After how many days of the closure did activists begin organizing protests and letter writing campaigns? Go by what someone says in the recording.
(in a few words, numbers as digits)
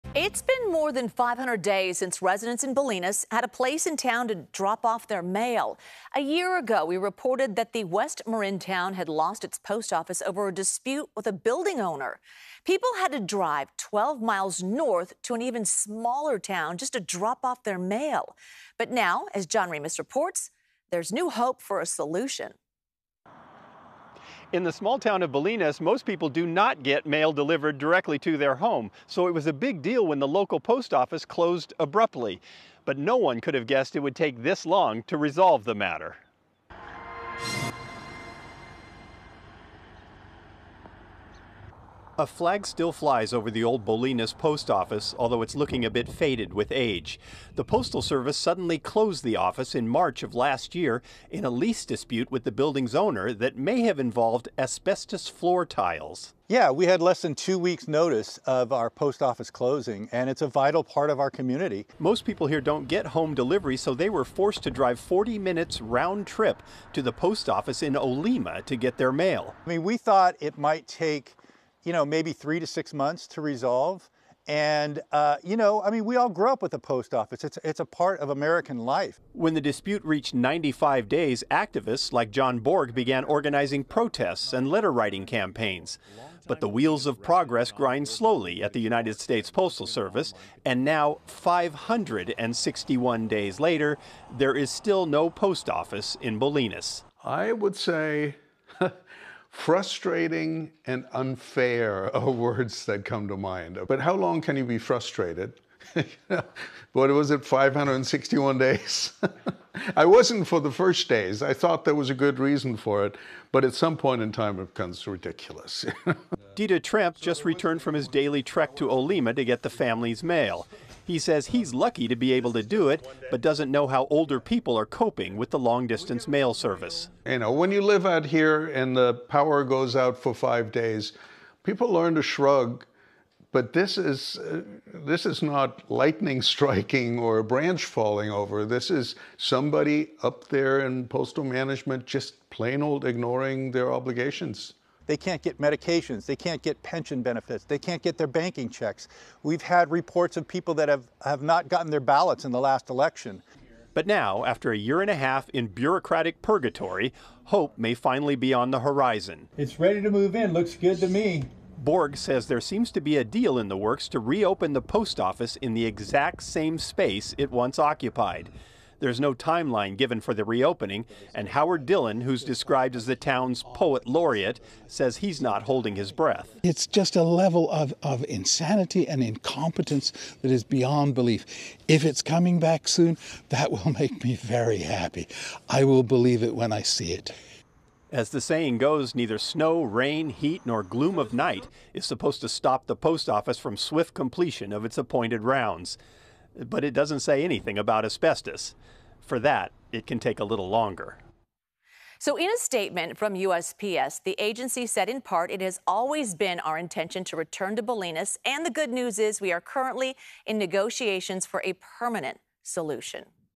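95.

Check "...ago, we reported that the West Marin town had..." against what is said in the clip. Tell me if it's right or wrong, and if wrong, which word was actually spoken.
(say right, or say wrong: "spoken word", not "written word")
right.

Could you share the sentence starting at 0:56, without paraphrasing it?
Yeah, we had less than two weeks' notice of our post office closing, and it's a vital part of our community.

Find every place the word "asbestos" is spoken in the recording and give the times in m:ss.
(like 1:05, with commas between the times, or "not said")
0:54, 3:18.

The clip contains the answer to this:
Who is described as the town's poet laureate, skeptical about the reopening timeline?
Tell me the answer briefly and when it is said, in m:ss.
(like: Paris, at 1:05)
Howard Dillon, at 2:51.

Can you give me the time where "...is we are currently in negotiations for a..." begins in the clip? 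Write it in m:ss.
3:29.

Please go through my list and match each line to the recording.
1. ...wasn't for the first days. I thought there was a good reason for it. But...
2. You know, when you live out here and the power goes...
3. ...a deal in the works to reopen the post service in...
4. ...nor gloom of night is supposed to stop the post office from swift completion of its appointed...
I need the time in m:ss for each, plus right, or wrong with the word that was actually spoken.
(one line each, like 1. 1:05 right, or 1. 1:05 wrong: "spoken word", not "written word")
1. 1:50 right
2. 2:07 right
3. 2:43 wrong: "office", not "service"
4. 3:10 right.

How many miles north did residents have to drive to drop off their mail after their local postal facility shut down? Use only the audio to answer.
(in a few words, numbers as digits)
12.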